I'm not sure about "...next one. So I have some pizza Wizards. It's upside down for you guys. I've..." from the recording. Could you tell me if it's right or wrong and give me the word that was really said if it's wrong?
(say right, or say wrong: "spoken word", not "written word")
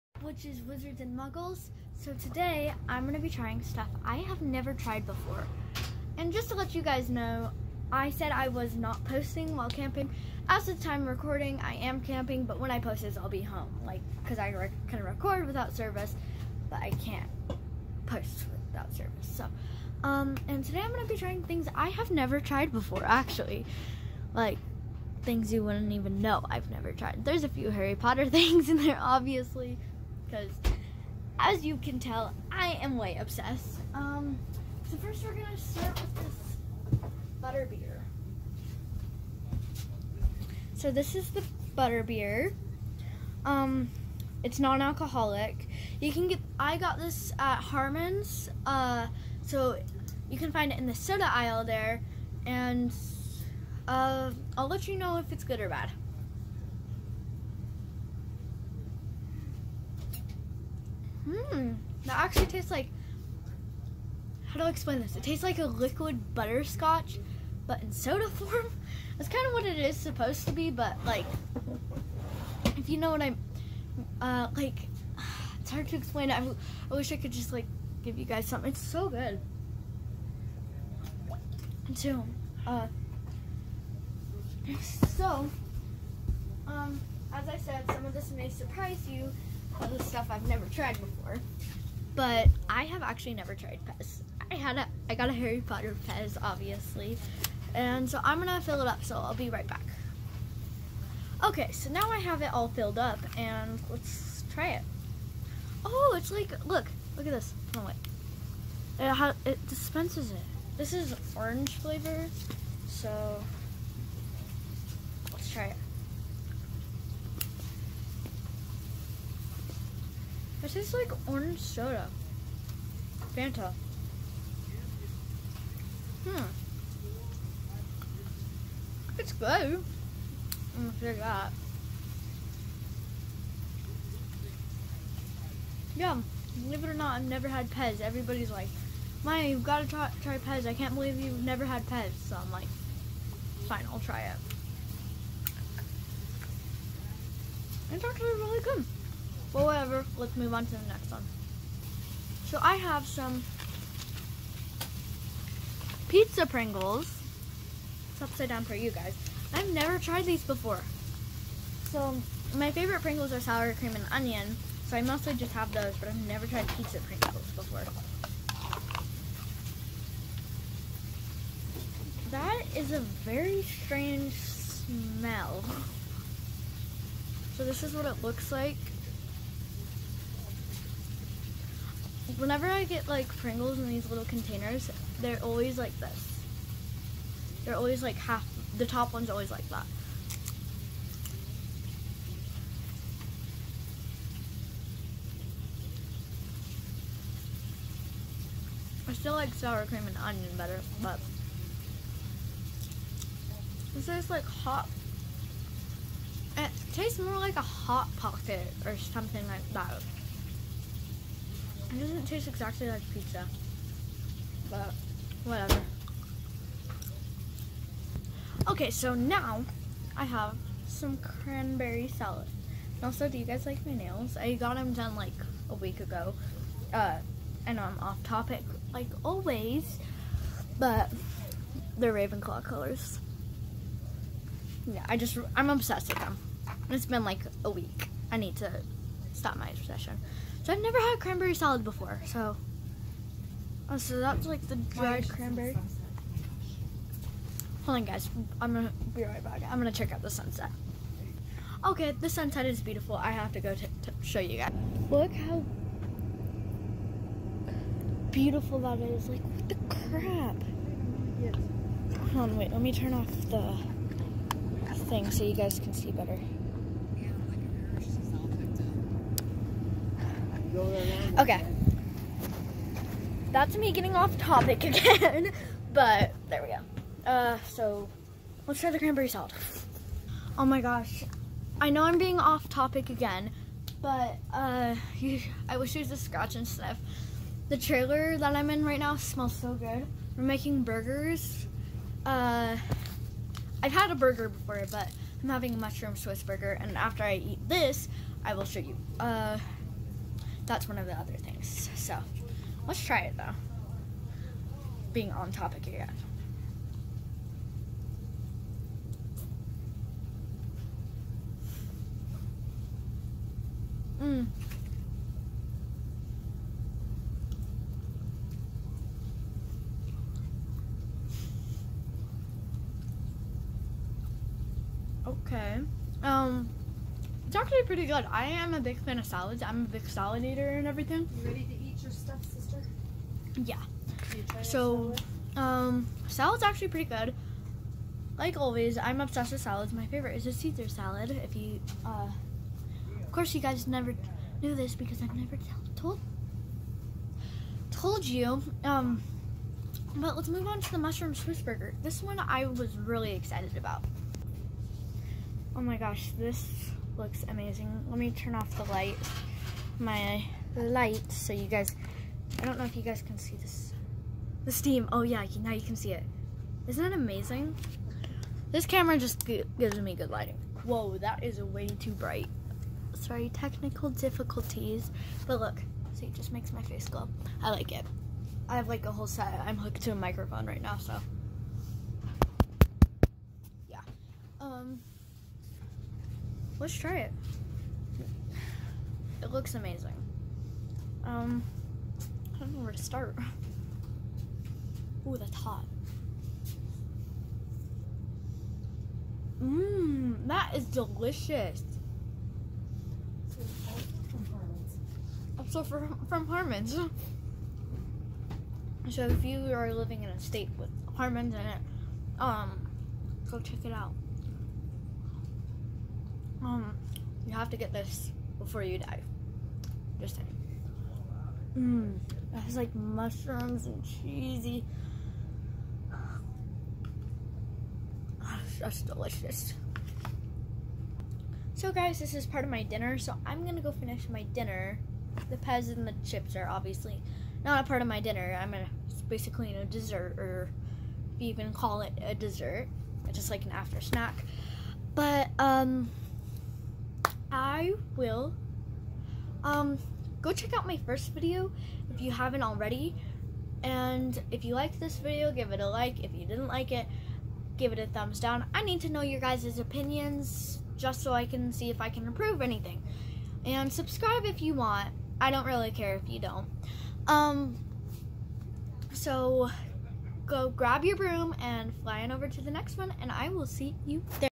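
wrong: "Pringles", not "Wizards".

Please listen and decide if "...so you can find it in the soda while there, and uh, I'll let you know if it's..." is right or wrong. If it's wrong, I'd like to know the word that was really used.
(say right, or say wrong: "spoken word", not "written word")
wrong: "aisle", not "while".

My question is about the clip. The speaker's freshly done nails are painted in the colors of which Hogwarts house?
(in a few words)
Ravenclaw.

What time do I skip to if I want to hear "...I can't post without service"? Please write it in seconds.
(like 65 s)
16 s.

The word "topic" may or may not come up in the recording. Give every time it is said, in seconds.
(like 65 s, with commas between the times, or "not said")
228 s, 274 s, 282 s, 305 s.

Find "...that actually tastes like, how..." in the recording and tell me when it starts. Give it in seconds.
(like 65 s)
62 s.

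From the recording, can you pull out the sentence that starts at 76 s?
I, I wish I could just like give you guys something.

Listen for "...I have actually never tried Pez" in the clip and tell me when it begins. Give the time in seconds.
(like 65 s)
92 s.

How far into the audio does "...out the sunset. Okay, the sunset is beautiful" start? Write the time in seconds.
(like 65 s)
250 s.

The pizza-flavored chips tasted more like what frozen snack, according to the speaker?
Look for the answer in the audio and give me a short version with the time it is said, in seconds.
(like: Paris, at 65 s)
Hot pocket, at 207 s.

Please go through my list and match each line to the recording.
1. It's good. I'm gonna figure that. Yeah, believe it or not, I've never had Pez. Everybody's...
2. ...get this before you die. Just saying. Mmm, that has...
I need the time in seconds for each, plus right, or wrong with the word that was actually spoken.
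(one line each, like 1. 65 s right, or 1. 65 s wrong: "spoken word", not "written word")
1. 129 s right
2. 417 s right.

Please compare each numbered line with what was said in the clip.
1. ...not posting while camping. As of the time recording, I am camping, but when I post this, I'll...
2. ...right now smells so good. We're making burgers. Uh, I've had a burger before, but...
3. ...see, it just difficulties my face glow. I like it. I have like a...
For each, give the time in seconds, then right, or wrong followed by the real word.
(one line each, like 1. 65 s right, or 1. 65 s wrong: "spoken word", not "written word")
1. 8 s right
2. 288 s right
3. 376 s wrong: "makes", not "difficulties".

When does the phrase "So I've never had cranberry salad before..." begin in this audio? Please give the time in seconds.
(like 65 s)
240 s.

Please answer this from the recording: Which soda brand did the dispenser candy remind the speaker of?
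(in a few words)
Fanta.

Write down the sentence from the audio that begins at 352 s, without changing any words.
This one I was really excited about.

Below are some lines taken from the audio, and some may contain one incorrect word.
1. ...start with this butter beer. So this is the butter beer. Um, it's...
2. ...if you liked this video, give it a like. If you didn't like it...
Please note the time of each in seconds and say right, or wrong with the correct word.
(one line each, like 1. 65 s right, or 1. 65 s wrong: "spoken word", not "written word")
1. 35 s right
2. 454 s right.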